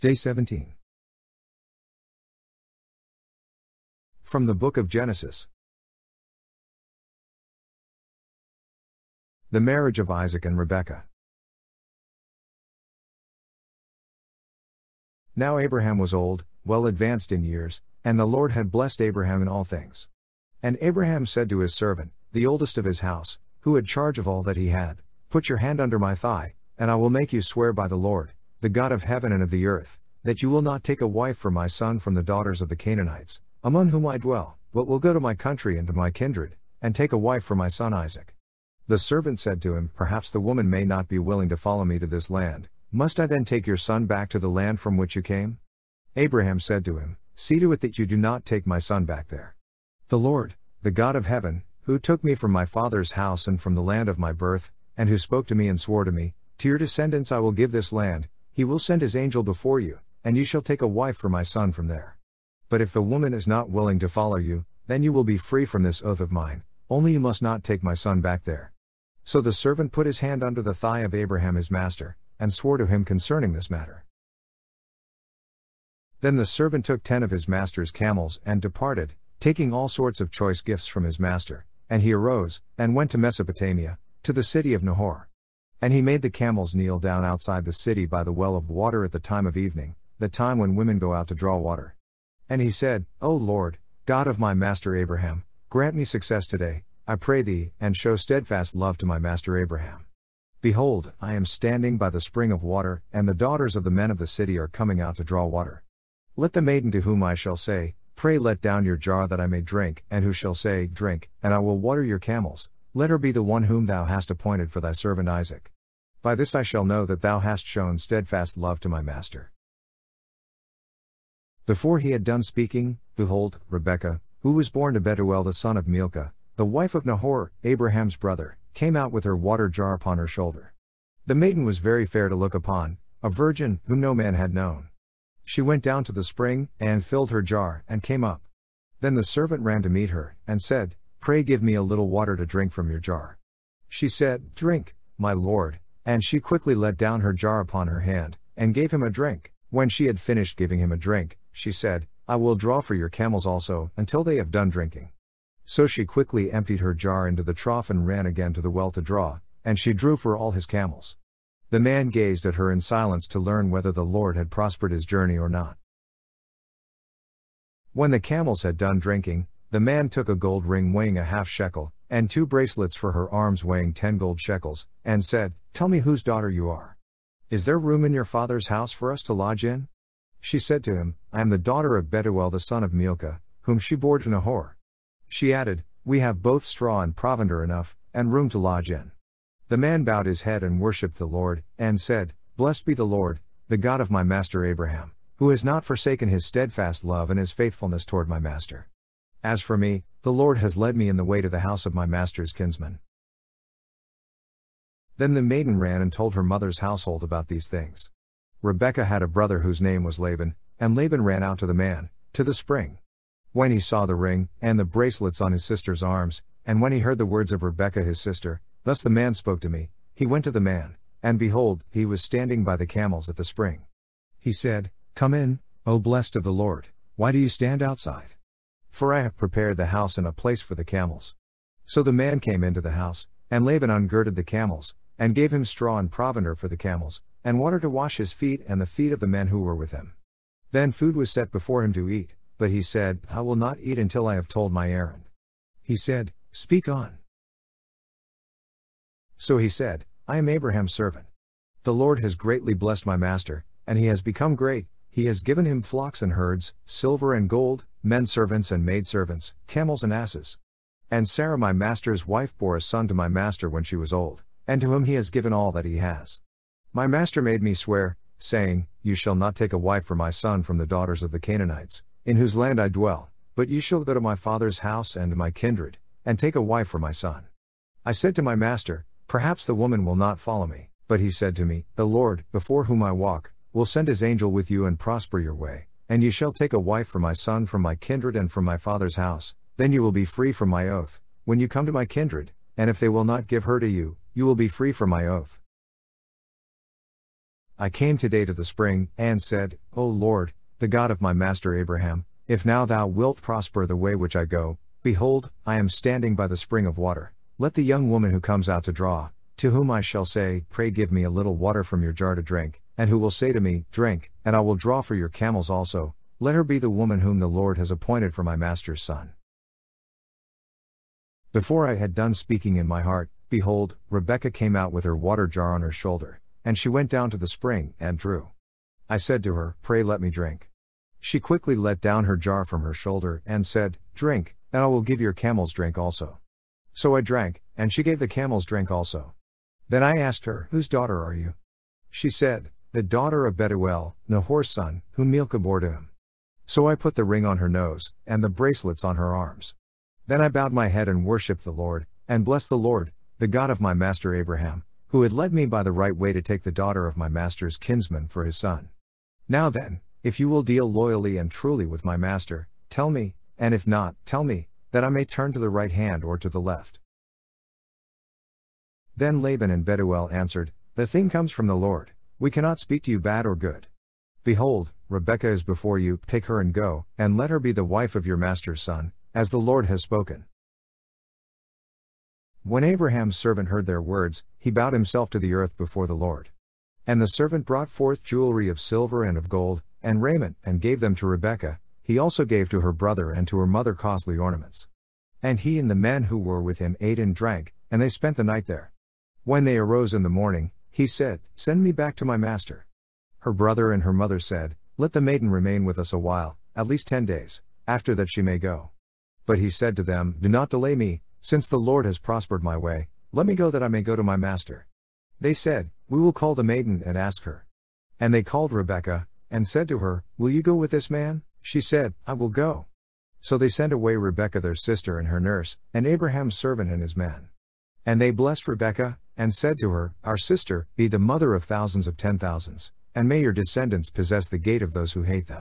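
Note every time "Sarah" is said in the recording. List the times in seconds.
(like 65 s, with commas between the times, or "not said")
261 s.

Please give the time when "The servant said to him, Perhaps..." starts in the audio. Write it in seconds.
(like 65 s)
38 s.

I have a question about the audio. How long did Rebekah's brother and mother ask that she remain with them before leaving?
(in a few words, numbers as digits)
10 days.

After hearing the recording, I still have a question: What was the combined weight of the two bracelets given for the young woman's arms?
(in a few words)
10 gold shekels.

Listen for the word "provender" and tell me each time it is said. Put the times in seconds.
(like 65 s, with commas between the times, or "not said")
187 s, 236 s.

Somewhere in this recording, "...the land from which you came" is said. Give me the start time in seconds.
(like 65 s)
44 s.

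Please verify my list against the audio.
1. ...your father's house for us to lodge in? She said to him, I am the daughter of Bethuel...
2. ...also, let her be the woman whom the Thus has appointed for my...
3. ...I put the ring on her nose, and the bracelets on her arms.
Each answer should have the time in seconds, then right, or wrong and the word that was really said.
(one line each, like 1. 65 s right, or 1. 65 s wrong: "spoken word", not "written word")
1. 178 s right
2. 315 s wrong: "Lord", not "Thus"
3. 346 s right.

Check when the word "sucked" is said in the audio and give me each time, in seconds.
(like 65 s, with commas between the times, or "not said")
not said.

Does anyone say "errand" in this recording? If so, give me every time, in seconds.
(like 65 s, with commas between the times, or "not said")
244 s.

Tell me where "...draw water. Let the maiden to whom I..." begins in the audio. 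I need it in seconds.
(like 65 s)
105 s.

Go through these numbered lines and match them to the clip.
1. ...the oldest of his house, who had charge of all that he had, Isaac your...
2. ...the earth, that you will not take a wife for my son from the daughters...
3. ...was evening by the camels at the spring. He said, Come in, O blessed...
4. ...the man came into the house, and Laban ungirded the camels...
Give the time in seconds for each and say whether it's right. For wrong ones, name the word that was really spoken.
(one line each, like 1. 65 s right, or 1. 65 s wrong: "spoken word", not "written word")
1. 22 s wrong: "Put", not "Isaac"
2. 29 s right
3. 222 s wrong: "standing", not "evening"
4. 232 s right.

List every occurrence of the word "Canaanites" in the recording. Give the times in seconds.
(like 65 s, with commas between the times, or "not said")
32 s, 271 s.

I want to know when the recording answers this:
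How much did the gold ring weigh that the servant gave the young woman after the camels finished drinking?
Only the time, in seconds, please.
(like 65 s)
171 s.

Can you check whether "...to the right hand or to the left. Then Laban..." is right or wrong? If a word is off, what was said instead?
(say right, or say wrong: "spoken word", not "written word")
right.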